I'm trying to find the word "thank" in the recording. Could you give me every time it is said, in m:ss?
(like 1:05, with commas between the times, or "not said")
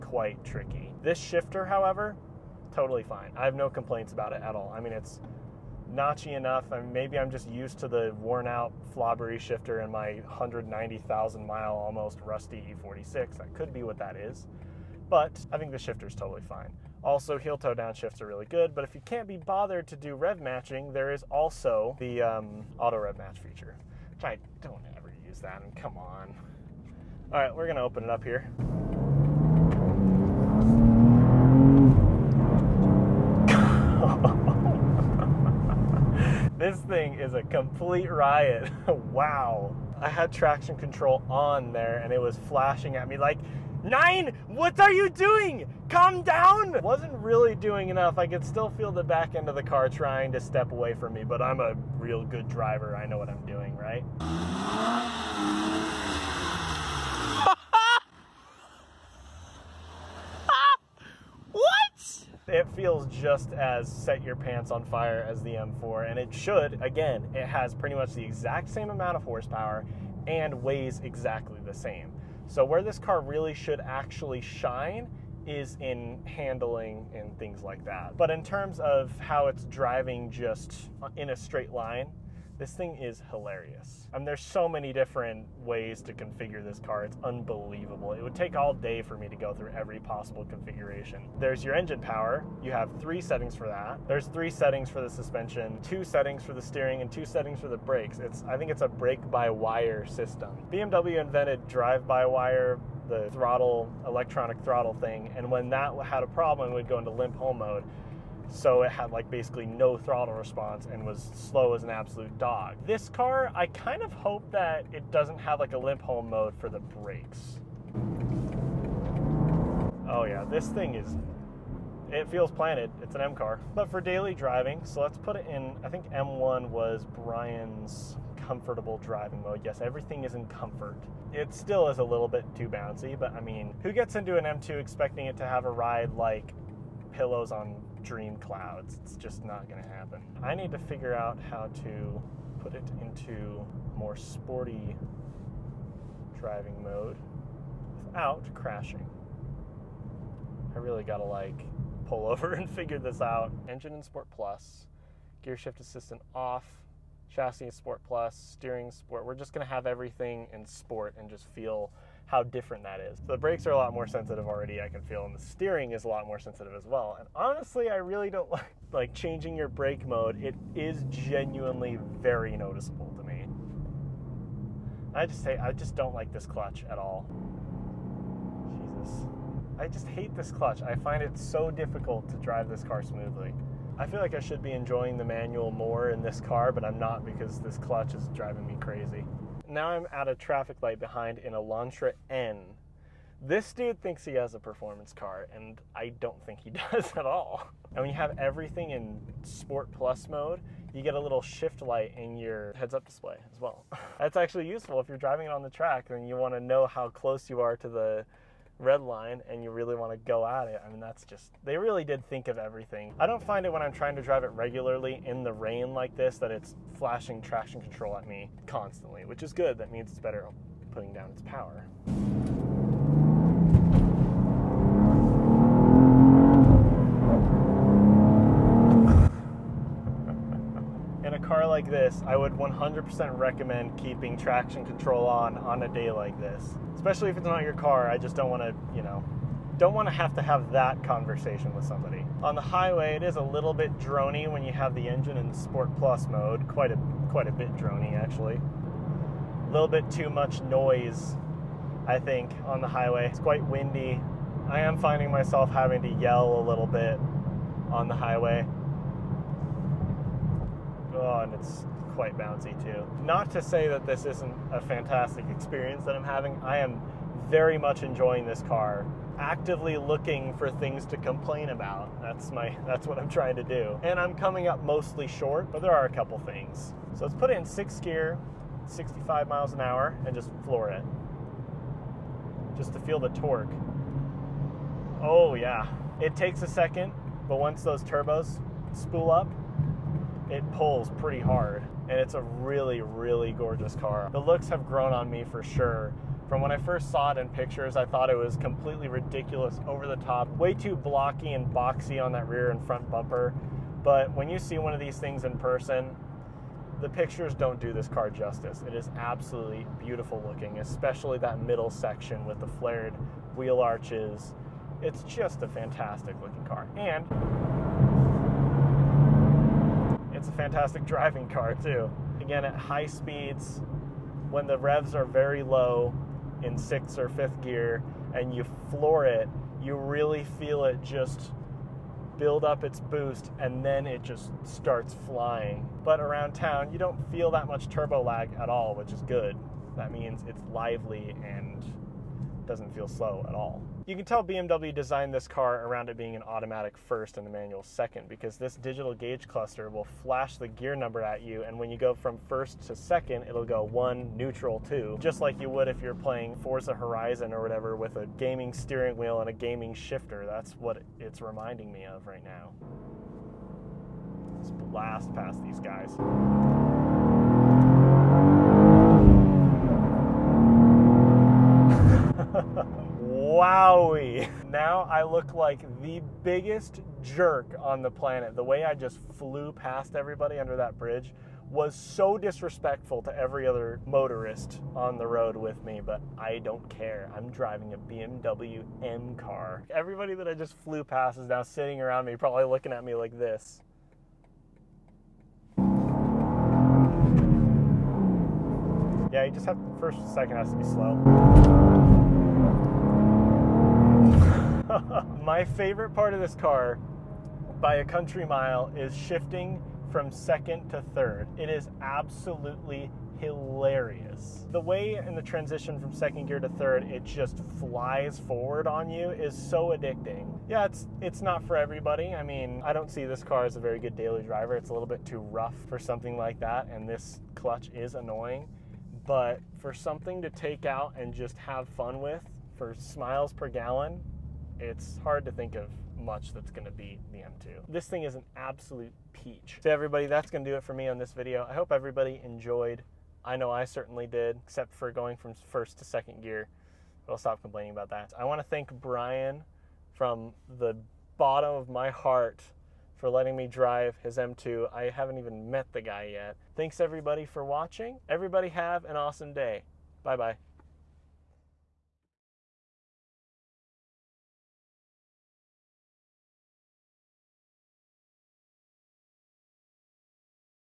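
7:28, 7:36.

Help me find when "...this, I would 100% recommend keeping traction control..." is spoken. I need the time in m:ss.
3:51.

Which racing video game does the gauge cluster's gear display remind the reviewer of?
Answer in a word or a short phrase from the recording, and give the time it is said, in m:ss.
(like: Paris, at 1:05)
Forza Horizon, at 5:56.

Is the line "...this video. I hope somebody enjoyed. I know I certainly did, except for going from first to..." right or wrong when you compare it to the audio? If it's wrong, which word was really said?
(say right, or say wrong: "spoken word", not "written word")
wrong: "everybody", not "somebody".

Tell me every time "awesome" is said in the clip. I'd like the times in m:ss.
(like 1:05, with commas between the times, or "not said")
7:39.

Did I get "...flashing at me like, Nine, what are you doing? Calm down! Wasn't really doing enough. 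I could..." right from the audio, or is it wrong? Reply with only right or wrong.
right.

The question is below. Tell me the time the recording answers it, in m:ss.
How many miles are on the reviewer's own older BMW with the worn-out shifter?
0:10.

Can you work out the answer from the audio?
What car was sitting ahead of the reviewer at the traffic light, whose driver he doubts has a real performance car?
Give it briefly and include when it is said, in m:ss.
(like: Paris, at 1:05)
Elantra N, at 3:11.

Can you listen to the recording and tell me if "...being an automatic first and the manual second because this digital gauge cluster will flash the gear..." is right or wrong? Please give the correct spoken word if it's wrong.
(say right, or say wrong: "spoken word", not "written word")
right.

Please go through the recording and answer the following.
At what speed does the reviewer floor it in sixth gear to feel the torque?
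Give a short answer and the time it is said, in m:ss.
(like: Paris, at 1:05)
65 mph, at 4:38.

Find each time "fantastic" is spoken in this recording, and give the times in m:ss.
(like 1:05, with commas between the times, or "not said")
4:24, 5:15, 5:20.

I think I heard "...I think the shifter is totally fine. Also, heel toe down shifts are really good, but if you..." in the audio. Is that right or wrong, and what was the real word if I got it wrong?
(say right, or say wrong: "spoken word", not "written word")
right.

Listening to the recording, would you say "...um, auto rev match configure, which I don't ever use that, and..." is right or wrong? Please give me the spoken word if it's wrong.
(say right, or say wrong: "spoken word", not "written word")
wrong: "feature", not "configure".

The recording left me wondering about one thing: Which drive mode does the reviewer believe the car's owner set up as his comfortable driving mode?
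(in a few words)
M1.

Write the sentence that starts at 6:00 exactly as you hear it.
That's what it's reminding me of right now.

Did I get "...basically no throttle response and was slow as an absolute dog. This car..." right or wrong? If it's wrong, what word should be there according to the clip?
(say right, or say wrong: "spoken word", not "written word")
right.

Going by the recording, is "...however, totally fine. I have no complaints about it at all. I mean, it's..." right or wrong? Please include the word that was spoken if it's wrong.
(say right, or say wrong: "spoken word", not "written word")
right.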